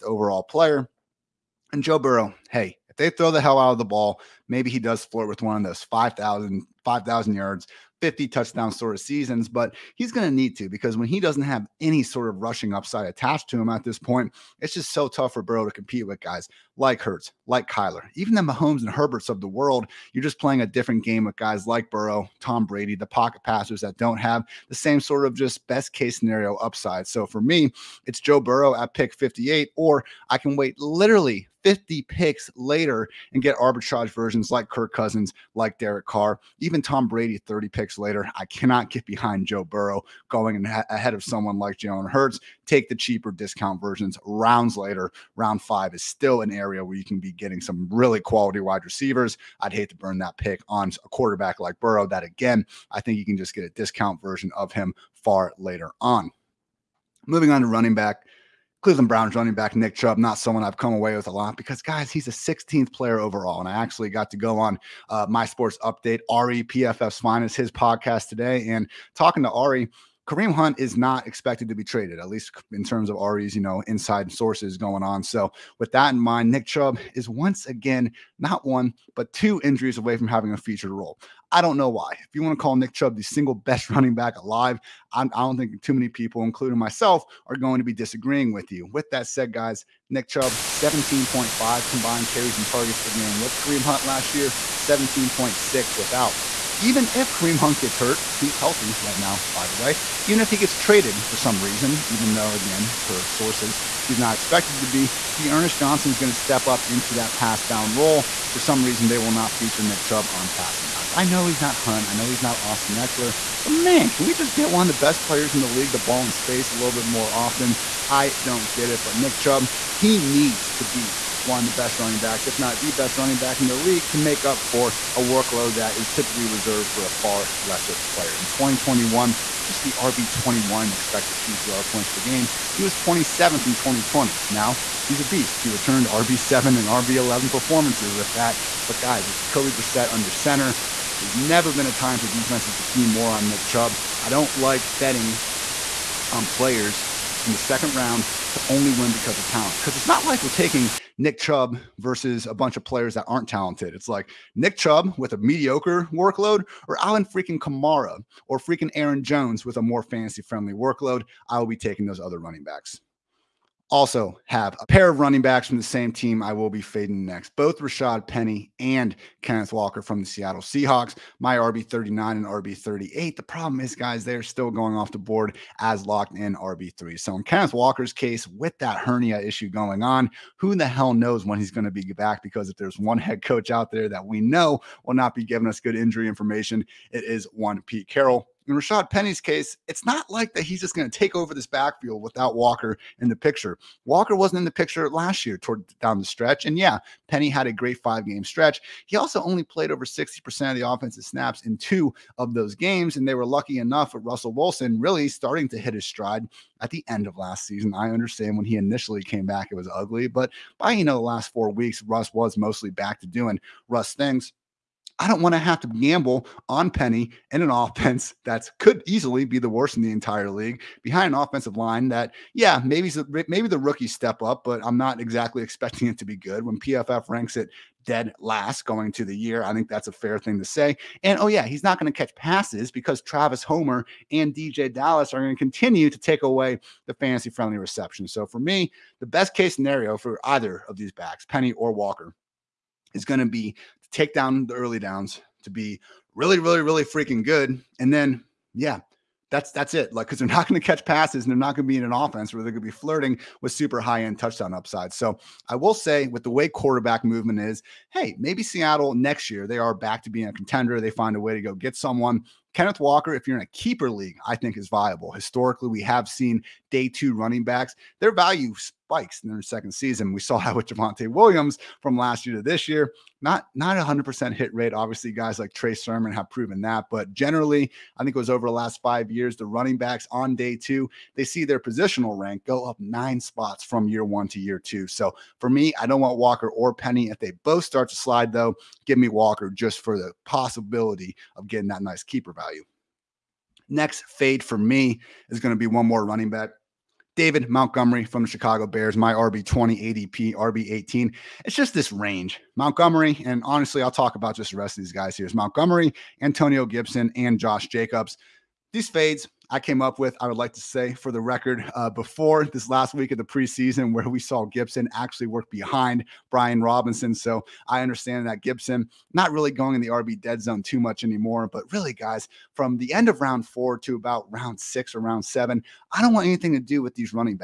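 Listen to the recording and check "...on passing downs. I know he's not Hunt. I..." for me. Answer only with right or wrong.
right.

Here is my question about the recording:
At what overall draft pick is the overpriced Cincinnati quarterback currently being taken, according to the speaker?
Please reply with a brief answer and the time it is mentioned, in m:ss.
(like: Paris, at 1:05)
58, at 0:28.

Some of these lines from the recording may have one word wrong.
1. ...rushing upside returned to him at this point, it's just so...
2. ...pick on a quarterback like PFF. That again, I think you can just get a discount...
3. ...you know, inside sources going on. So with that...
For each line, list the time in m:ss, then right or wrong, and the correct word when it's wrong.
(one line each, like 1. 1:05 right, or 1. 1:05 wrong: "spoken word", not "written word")
1. 0:12 wrong: "attached", not "returned"
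2. 0:50 wrong: "Burrow", not "PFF"
3. 1:13 right.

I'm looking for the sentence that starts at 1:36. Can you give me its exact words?
Even if Kareem Hunt gets hurt, He's healthy right now, by the way.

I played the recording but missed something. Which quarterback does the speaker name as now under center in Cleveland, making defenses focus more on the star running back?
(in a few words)
Jacoby Brissett.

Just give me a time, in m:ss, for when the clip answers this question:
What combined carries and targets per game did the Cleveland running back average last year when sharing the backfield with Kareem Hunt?
1:30.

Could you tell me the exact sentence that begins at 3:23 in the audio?
And they were lucky enough with Russell Wilson really starting to hit his stride at the end of last season.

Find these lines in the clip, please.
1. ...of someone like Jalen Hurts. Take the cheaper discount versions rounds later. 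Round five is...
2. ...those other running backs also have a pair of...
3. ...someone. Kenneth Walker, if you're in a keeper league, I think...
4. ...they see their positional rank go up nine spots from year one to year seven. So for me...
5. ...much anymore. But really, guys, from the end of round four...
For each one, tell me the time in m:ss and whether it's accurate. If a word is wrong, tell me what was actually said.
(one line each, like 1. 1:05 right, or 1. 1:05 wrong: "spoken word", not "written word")
1. 0:41 right
2. 2:42 right
3. 4:21 right
4. 4:41 wrong: "two", not "seven"
5. 5:20 right.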